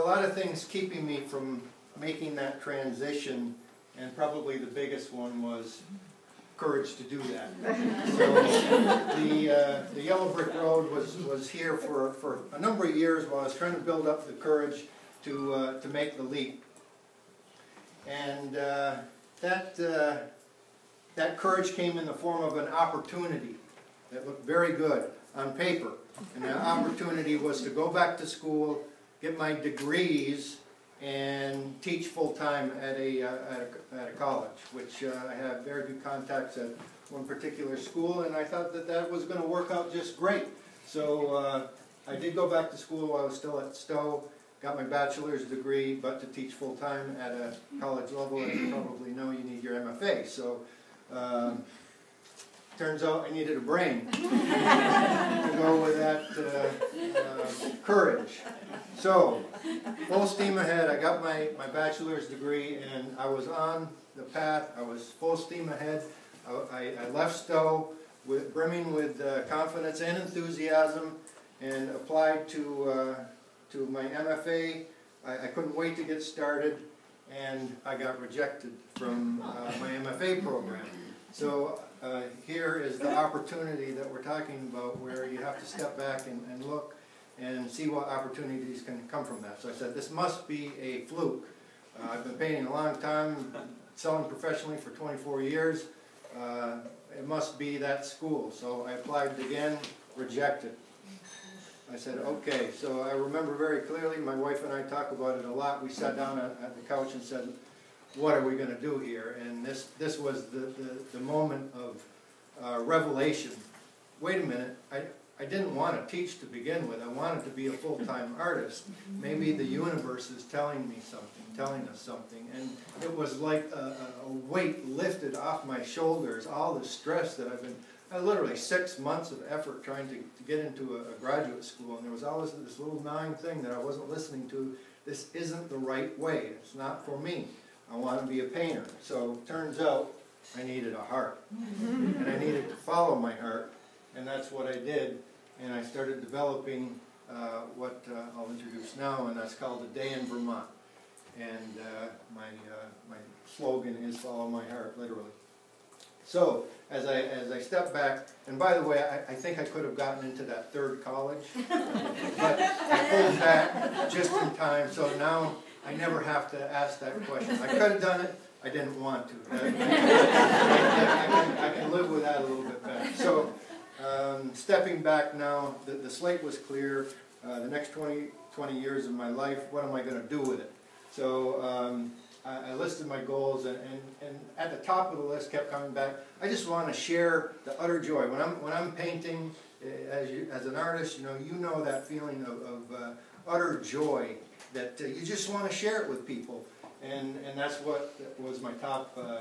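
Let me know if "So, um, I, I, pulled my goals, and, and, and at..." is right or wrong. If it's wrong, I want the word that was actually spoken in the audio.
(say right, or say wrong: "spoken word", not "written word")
wrong: "listed", not "pulled".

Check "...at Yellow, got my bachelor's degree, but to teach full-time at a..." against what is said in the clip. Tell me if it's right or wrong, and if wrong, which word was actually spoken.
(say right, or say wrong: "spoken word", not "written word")
wrong: "Sto", not "Yellow".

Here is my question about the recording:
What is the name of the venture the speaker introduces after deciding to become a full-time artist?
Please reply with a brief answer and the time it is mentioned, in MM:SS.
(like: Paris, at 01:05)
A Day in Vermont, at 02:29.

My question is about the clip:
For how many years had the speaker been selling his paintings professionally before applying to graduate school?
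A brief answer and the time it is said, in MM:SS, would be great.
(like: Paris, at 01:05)
24, at 01:34.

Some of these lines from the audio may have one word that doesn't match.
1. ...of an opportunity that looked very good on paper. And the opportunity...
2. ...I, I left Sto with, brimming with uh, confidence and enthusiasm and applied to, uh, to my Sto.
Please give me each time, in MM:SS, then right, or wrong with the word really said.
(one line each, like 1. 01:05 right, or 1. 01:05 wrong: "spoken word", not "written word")
1. 00:22 right
2. 01:06 wrong: "MFA", not "Sto".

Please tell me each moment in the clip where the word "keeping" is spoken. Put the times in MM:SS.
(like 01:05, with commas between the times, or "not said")
00:00.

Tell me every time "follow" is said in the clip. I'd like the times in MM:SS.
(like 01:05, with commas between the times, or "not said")
02:22, 02:34.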